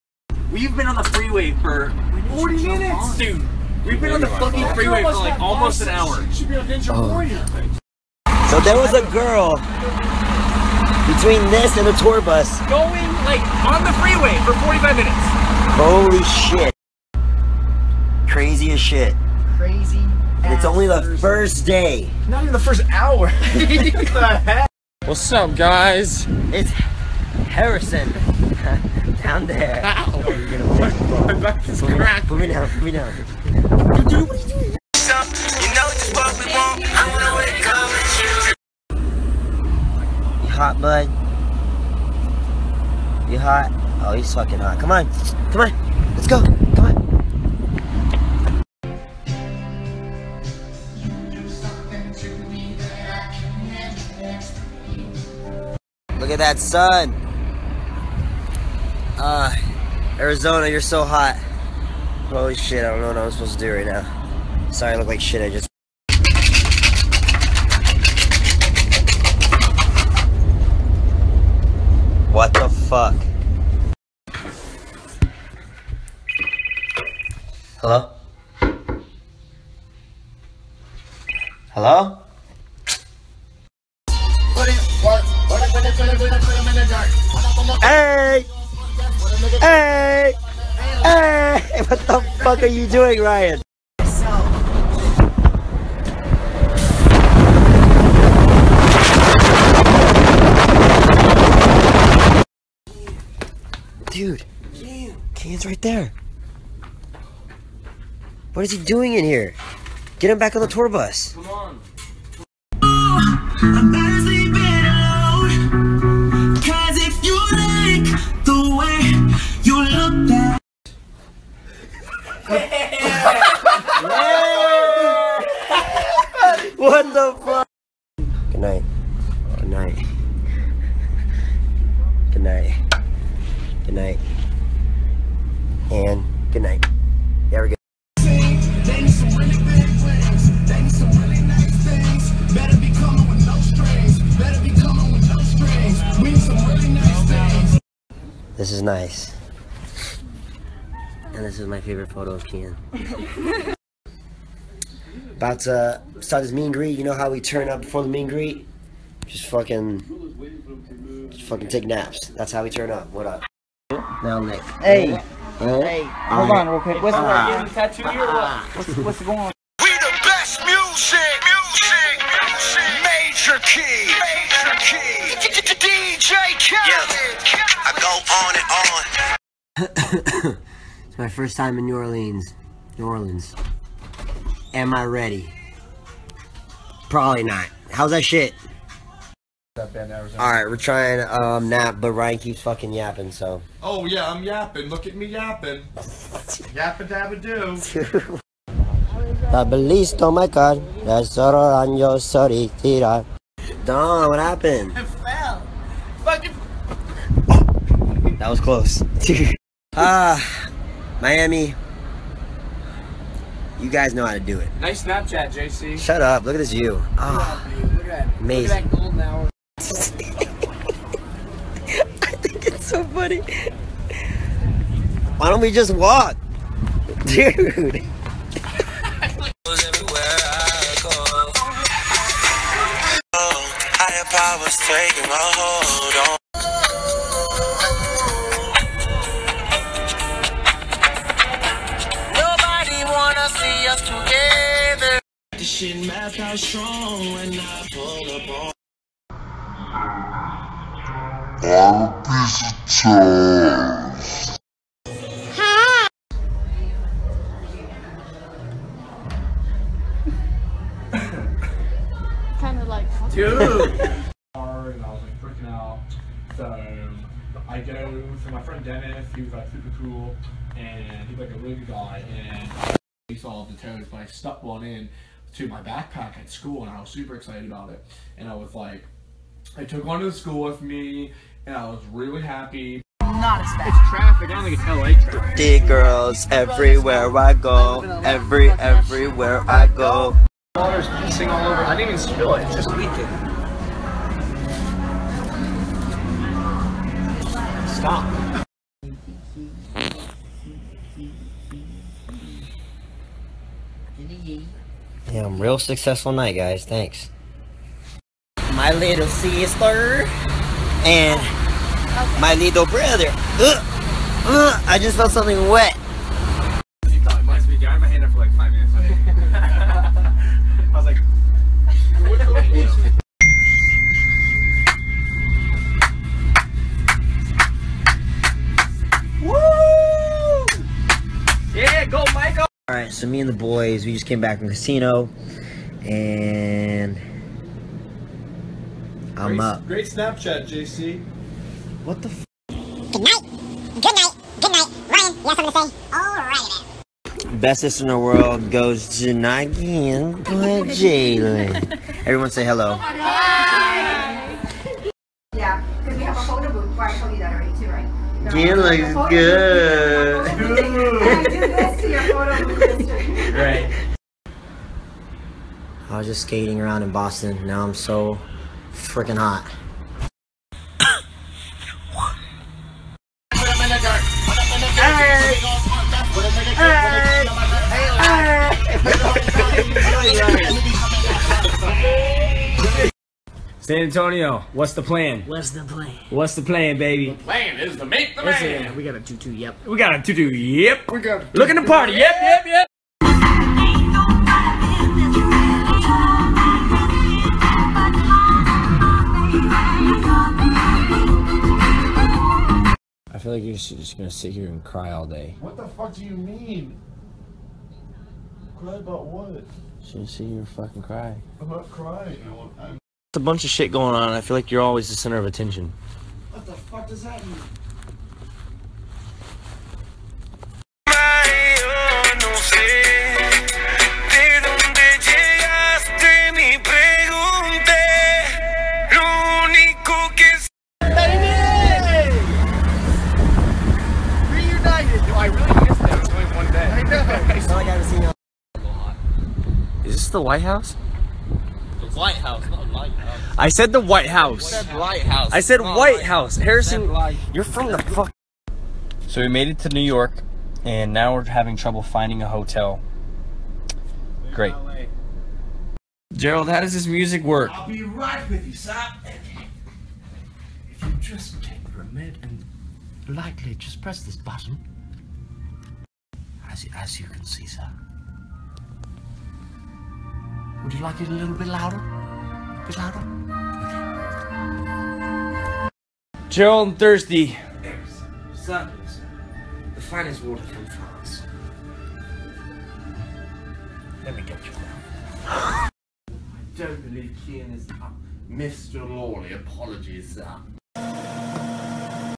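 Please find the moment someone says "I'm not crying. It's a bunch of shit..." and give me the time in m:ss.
6:51.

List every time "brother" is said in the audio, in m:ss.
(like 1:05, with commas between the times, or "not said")
5:12.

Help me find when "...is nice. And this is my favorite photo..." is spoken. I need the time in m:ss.
2:28.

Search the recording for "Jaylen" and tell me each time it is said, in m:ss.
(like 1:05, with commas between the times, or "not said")
5:50.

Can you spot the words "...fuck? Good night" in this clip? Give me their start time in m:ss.
2:07.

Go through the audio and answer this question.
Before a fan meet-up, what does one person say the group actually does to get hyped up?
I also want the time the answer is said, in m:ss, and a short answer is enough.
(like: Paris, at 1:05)
Take naps, at 2:41.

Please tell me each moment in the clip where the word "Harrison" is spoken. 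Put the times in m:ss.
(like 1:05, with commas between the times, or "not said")
0:27, 7:26.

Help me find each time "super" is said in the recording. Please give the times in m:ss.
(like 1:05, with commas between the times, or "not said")
4:29, 4:37.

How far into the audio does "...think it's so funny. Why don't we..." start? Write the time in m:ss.
3:42.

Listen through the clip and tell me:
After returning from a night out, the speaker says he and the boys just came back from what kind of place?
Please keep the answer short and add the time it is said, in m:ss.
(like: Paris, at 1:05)
Casino, at 5:34.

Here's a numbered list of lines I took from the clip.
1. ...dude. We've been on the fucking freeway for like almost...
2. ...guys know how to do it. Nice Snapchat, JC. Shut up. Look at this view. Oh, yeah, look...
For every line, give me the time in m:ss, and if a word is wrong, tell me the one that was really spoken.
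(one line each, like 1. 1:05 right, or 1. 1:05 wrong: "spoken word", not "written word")
1. 0:03 right
2. 3:33 right.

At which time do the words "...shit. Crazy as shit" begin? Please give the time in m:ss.
0:16.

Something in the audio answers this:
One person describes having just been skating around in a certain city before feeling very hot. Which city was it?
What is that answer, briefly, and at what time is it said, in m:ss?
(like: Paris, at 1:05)
Boston, at 6:07.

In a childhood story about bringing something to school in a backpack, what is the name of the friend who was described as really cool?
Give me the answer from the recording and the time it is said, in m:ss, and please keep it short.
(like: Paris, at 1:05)
Dennis, at 4:28.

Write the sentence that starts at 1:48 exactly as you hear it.
What is he doing in here?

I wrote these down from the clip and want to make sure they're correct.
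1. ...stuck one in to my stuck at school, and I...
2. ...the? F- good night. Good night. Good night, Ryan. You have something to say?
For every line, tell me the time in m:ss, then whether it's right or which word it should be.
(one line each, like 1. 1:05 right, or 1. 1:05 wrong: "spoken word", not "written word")
1. 4:34 wrong: "backpack", not "stuck"
2. 5:42 right.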